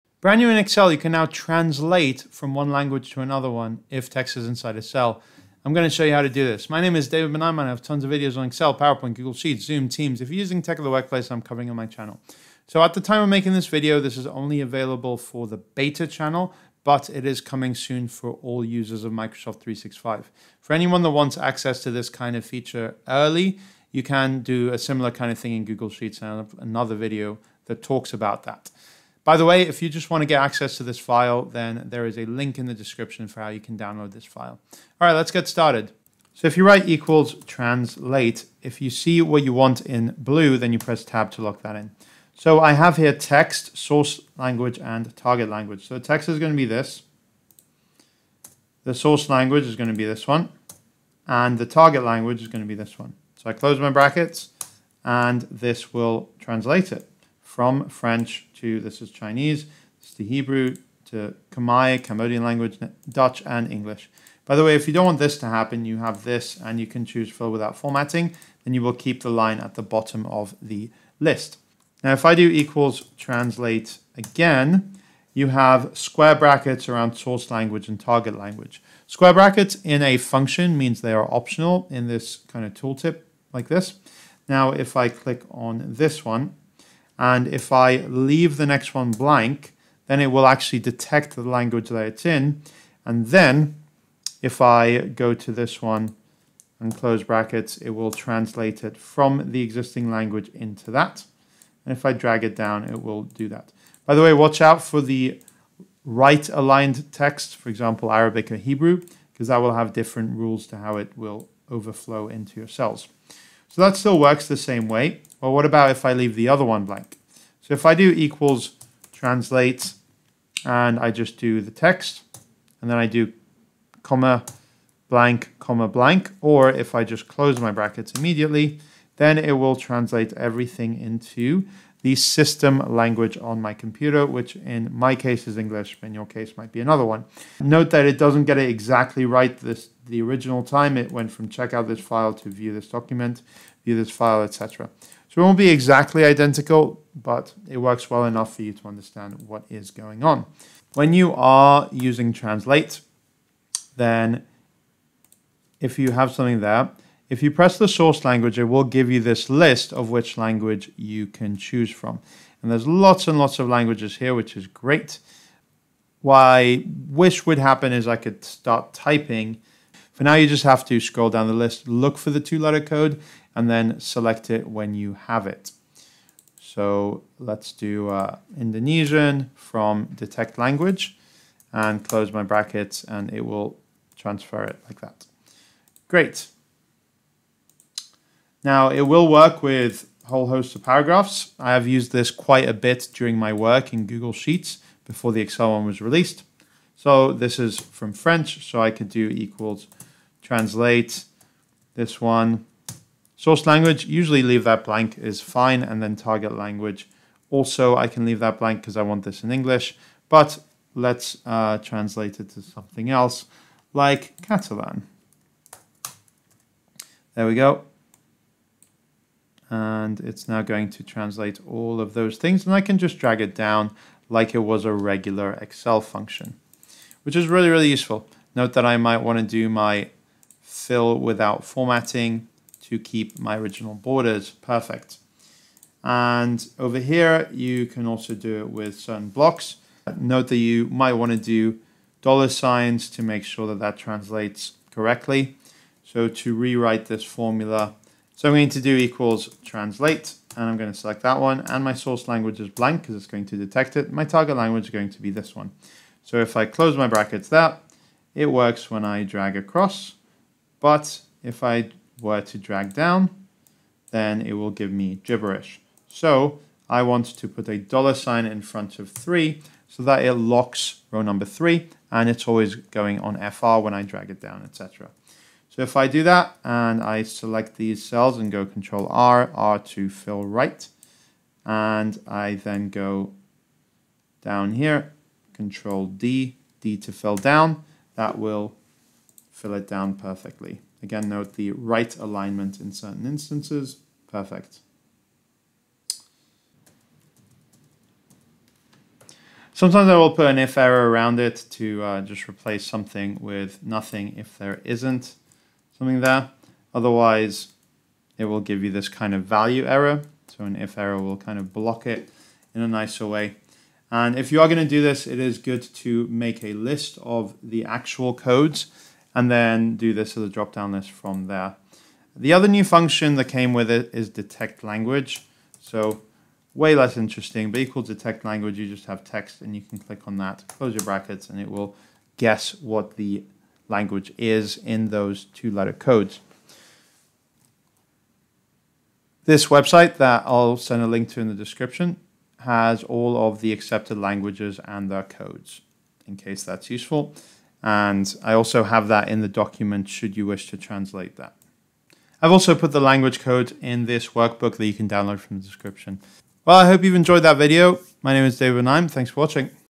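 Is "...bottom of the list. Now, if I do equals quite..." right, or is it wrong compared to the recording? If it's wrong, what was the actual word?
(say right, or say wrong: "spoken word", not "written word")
wrong: "translate", not "quite".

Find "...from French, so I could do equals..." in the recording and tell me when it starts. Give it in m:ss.
3:17.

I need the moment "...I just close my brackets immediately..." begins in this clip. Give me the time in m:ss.
2:06.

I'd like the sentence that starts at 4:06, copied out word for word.
So to rewrite this formula, so I'm going to do equals translate, and I'm going to select that one.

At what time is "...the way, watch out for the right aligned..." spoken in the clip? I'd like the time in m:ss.
1:44.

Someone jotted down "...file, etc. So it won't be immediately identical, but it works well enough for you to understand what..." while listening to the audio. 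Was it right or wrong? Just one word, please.
wrong.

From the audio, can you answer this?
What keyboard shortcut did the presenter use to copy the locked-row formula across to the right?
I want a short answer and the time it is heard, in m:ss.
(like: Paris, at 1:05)
Control R, at 4:38.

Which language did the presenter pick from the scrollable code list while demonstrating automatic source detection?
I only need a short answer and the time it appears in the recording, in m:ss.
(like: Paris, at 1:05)
Indonesian, at 2:58.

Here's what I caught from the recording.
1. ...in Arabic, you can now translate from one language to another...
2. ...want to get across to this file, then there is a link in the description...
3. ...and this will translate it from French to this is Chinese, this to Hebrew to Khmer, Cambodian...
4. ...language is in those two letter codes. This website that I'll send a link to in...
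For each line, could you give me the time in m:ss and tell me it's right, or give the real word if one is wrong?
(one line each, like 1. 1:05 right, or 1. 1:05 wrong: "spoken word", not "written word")
1. 0:00 wrong: "Excel", not "Arabic"
2. 0:30 wrong: "access", not "across"
3. 0:55 right
4. 5:33 right.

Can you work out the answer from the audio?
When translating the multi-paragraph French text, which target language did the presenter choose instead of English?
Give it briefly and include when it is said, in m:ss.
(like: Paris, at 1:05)
Catalan, at 3:34.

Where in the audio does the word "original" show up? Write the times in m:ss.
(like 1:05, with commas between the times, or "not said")
2:20, 3:53.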